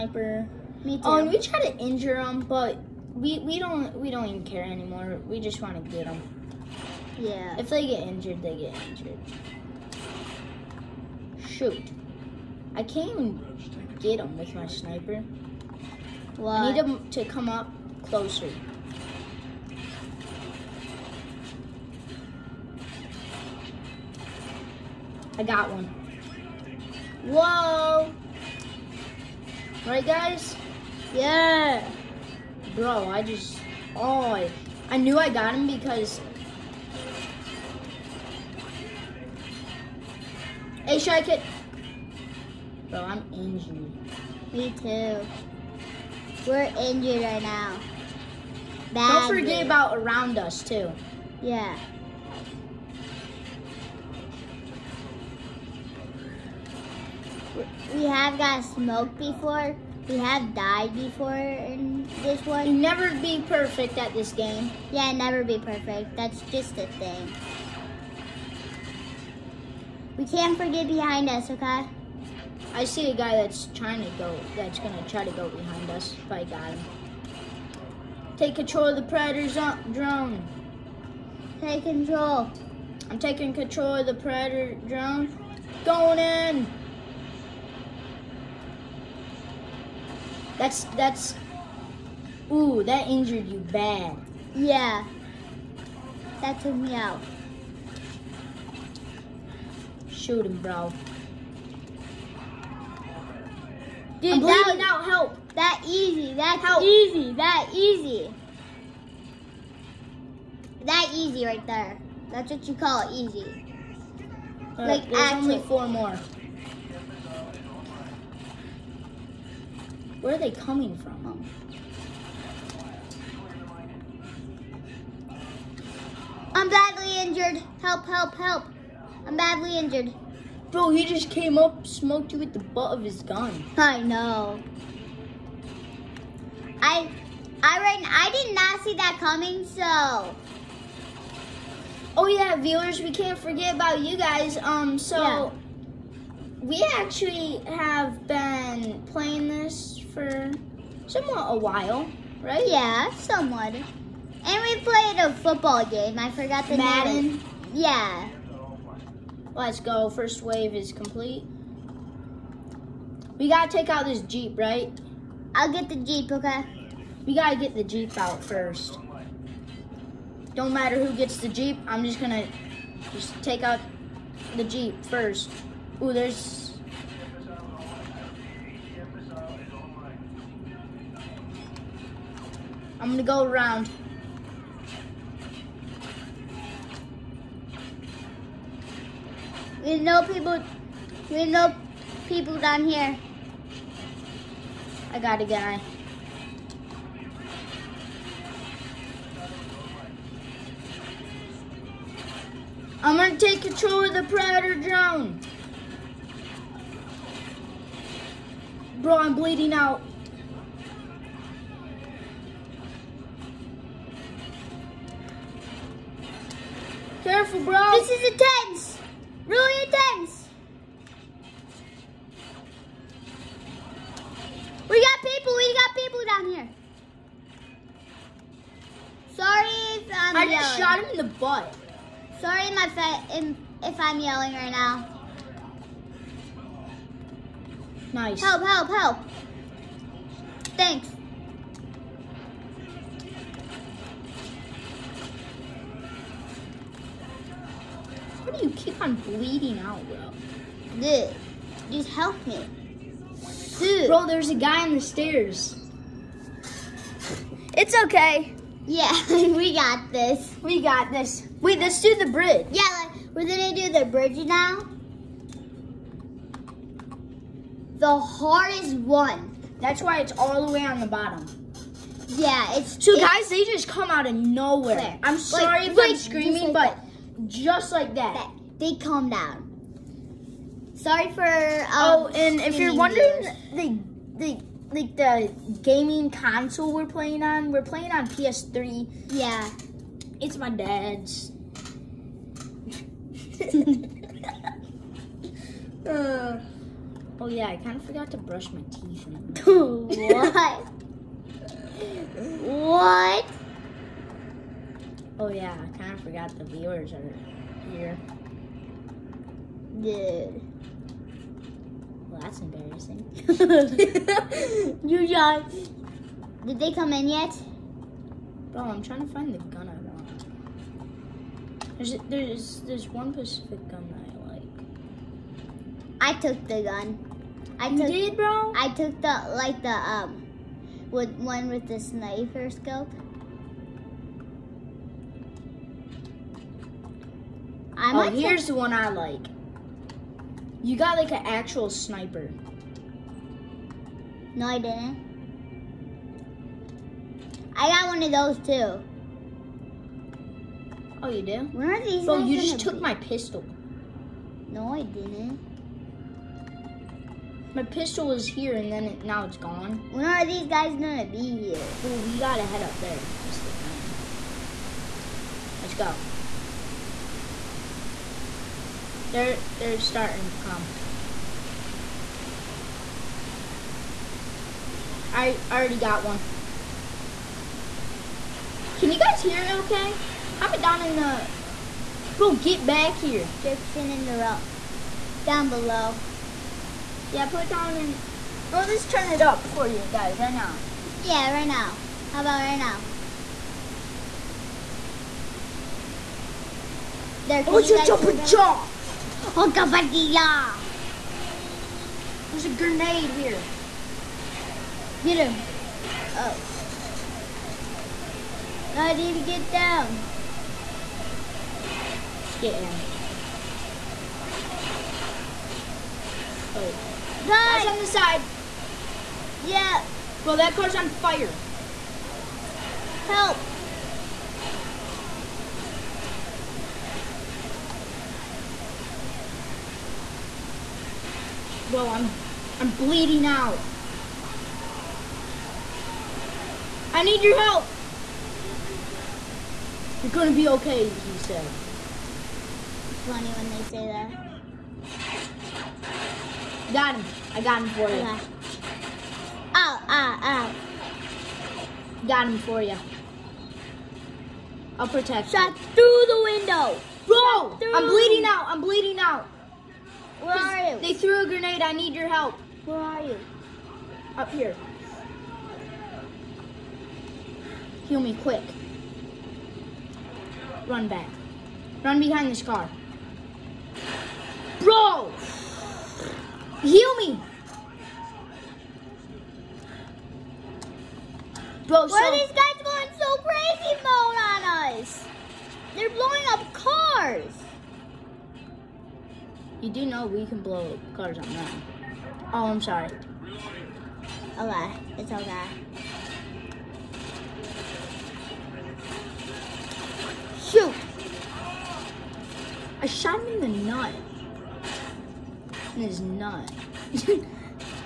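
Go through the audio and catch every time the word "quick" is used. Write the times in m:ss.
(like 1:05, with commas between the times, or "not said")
7:48.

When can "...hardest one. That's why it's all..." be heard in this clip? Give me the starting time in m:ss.
4:28.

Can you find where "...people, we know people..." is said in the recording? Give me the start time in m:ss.
3:10.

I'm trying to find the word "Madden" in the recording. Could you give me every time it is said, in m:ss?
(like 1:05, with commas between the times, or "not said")
2:36.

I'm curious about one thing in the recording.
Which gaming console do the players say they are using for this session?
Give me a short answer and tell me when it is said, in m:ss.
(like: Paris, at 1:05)
PS3, at 4:48.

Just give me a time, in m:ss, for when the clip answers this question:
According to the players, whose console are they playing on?
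4:50.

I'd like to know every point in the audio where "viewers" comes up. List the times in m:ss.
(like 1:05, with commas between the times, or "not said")
2:22, 5:06.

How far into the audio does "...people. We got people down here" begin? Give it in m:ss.
3:45.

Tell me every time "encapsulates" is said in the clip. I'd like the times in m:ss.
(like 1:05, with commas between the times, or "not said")
not said.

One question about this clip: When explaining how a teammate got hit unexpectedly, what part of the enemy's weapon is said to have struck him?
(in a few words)
butt of his gun.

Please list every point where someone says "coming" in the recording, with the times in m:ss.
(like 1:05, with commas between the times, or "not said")
2:00, 2:19.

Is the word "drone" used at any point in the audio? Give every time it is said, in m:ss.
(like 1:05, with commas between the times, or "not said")
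1:19, 1:24, 3:24.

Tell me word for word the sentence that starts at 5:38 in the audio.
I oh, here's the one I like.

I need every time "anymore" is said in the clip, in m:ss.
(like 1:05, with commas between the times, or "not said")
0:04.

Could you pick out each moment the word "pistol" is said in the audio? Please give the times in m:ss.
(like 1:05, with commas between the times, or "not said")
5:53, 5:57.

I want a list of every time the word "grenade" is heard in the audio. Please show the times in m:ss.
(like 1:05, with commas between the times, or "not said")
6:42, 7:41.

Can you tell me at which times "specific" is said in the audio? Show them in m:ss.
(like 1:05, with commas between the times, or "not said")
5:23.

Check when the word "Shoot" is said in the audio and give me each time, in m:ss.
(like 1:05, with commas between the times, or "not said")
0:11, 1:40, 8:20.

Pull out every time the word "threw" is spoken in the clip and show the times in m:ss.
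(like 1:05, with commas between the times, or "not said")
7:41.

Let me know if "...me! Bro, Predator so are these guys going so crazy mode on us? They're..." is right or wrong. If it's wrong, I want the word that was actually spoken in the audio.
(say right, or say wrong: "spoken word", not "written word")
wrong: "Why", not "Predator".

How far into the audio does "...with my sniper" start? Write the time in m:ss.
0:14.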